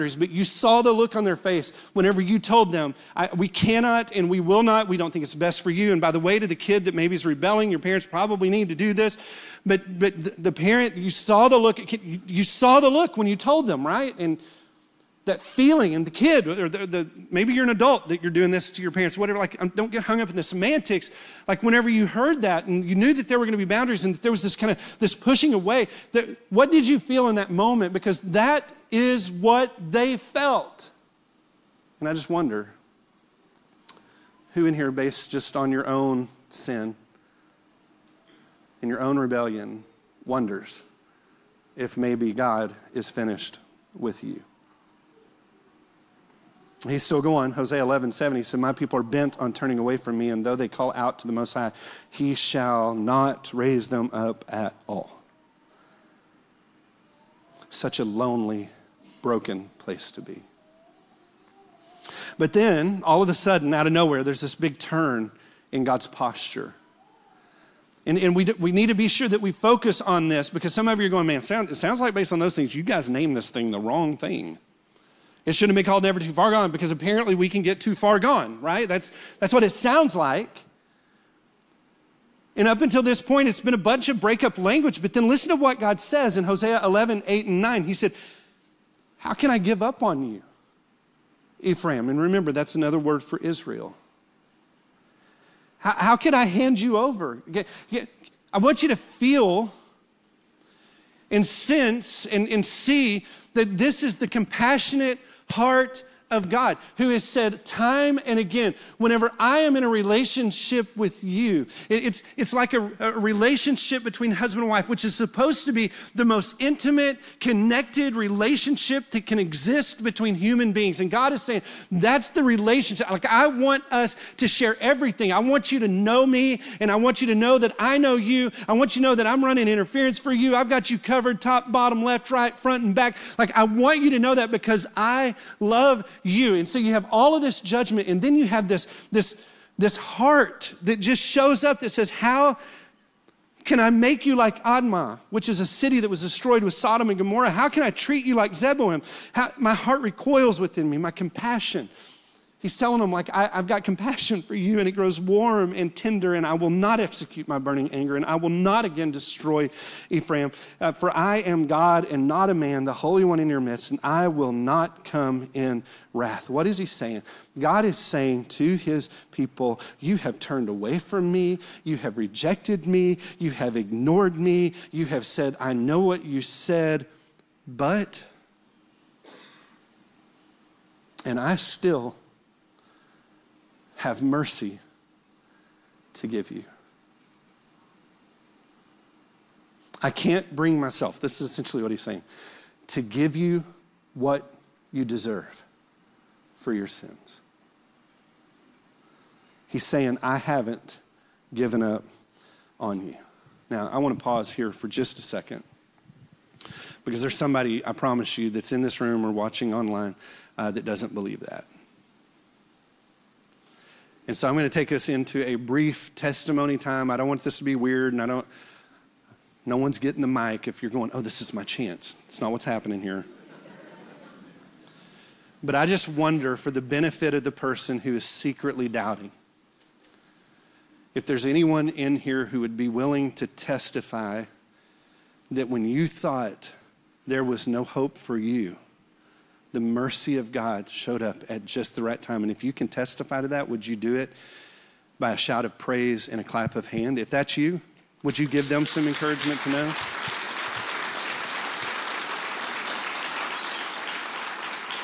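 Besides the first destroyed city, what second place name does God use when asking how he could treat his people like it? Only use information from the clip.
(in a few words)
Zeboim.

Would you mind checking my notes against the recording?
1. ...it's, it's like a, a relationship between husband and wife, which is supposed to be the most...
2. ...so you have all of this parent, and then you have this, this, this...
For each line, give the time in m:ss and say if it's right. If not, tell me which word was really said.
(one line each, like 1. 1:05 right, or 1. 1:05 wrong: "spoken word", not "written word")
1. 1:51 right
2. 2:16 wrong: "judgment", not "parent".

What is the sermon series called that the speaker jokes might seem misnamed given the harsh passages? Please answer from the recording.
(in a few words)
Never Too Far Gone.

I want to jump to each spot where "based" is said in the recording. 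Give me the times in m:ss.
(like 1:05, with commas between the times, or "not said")
0:34, 1:12.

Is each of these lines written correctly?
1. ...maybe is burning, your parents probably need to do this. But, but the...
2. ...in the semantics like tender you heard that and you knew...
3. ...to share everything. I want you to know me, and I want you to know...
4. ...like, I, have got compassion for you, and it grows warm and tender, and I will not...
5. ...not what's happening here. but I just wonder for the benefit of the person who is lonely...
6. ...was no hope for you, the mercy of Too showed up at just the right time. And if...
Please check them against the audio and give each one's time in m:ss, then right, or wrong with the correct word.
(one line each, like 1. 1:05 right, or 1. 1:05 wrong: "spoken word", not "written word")
1. 0:06 wrong: "rebelling", not "burning"
2. 0:20 wrong: "whenever", not "tender"
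3. 2:04 right
4. 2:33 right
5. 3:42 wrong: "secretly", not "lonely"
6. 3:57 wrong: "God", not "Too".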